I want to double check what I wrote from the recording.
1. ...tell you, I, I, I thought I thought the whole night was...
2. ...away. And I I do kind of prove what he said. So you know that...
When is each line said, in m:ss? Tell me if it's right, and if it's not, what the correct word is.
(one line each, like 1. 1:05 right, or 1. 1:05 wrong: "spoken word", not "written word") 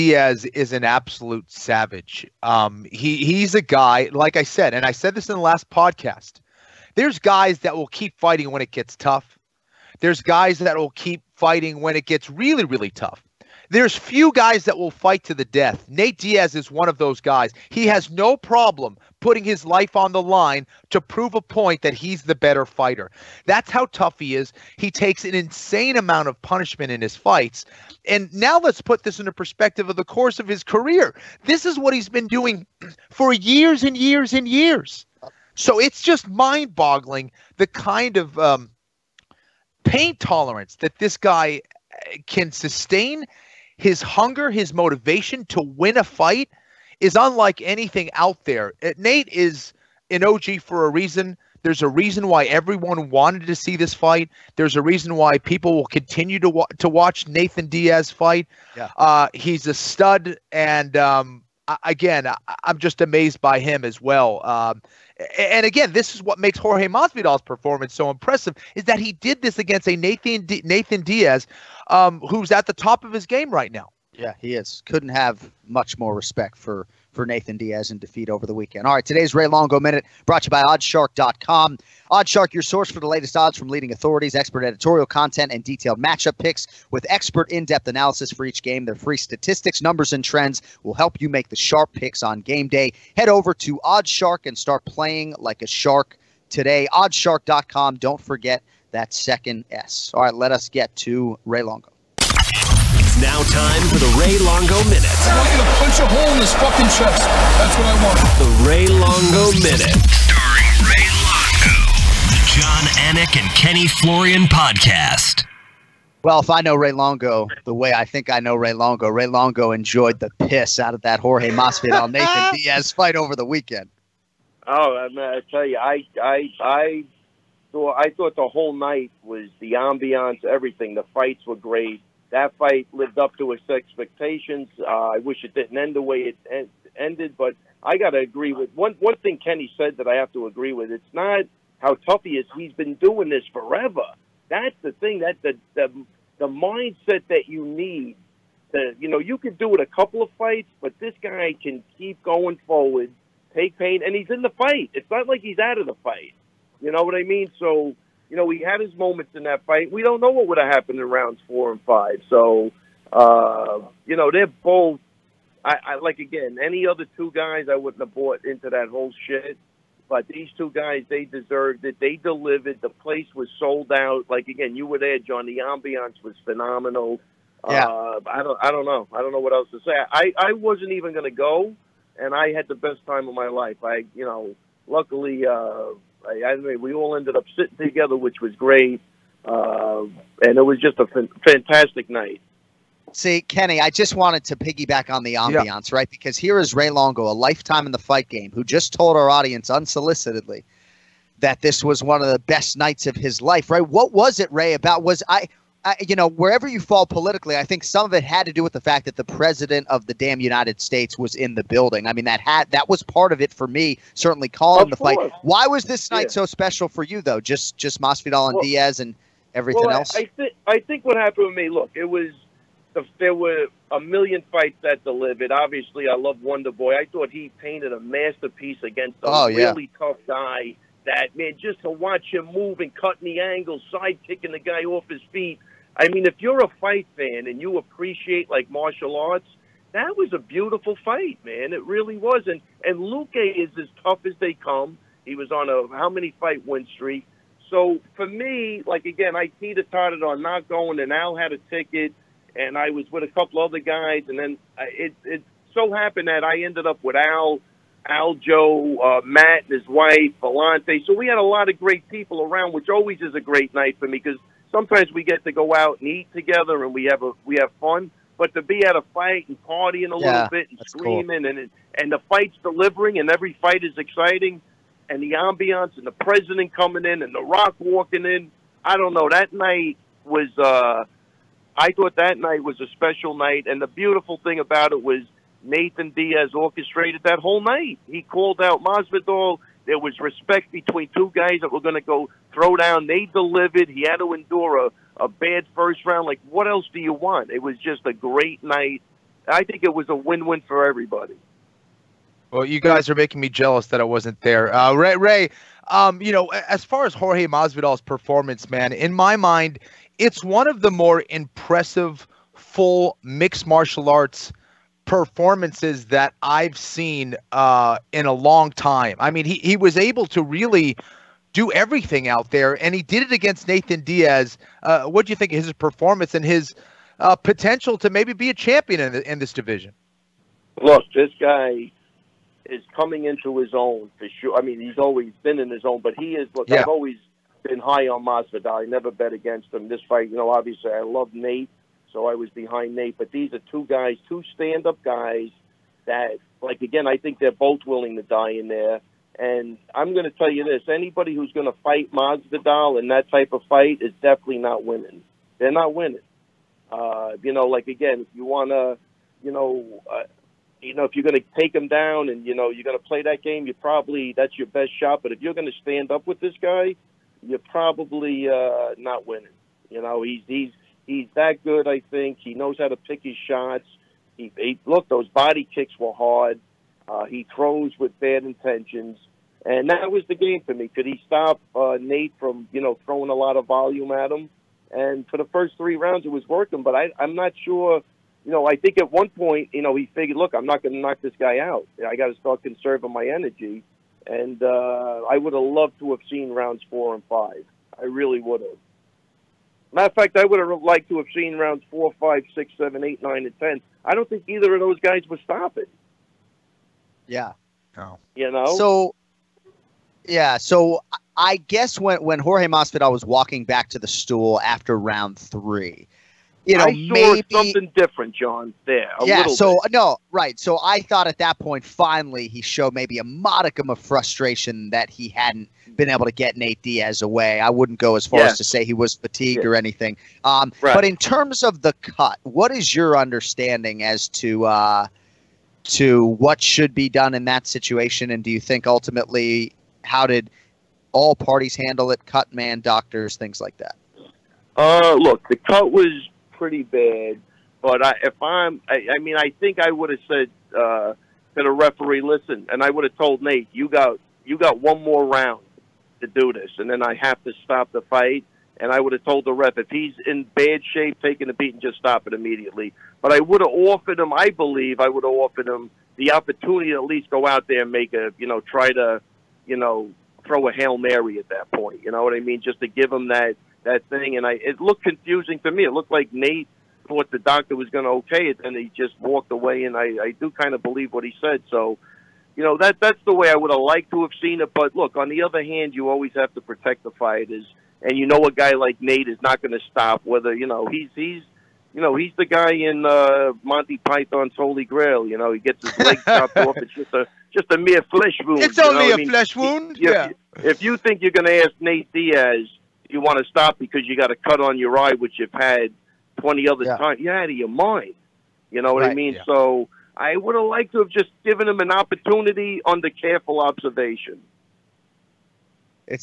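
1. 2:05 right
2. 7:59 wrong: "believe", not "prove".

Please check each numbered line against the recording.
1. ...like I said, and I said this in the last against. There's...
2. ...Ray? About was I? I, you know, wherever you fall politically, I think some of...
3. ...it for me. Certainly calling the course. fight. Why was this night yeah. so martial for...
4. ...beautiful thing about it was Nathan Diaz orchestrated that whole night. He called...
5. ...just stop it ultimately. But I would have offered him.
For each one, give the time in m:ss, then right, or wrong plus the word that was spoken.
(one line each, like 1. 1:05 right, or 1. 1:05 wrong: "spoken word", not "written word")
1. 0:04 wrong: "podcast", not "against"
2. 3:24 right
3. 3:33 wrong: "special", not "martial"
4. 4:43 right
5. 7:41 wrong: "immediately", not "ultimately".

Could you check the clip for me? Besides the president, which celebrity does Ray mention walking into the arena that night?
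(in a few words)
The Rock.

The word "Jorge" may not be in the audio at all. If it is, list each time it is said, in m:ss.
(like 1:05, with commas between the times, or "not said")
1:06, 2:01, 5:07, 6:52.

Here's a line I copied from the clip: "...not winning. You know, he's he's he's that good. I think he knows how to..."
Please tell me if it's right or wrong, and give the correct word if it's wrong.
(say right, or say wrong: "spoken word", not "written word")
right.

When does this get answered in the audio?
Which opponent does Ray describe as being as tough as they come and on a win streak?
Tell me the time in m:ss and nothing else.
4:02.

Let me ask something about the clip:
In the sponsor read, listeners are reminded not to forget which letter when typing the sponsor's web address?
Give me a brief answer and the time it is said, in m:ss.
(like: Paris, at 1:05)
second S, at 1:39.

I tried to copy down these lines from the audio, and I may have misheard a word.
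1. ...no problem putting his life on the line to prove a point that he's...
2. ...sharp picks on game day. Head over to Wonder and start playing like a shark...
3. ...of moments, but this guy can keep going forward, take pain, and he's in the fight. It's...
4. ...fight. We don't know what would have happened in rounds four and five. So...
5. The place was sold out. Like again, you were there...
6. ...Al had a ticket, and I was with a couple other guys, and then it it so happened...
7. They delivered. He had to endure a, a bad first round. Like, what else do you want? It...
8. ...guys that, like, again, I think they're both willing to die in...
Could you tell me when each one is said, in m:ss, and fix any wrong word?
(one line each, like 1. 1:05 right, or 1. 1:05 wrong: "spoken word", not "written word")
1. 0:18 right
2. 1:31 wrong: "Oddshark", not "Wonder"
3. 2:30 wrong: "fights", not "moments"
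4. 2:39 right
5. 2:52 right
6. 4:11 right
7. 4:53 right
8. 5:45 right.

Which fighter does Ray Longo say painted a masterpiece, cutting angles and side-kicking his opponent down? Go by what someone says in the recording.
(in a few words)
Wonder Boy.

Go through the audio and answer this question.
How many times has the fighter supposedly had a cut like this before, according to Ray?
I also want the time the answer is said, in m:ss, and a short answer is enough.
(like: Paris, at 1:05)
20, at 8:26.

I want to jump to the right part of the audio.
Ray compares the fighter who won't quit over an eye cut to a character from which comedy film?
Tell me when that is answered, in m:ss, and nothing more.
8:13.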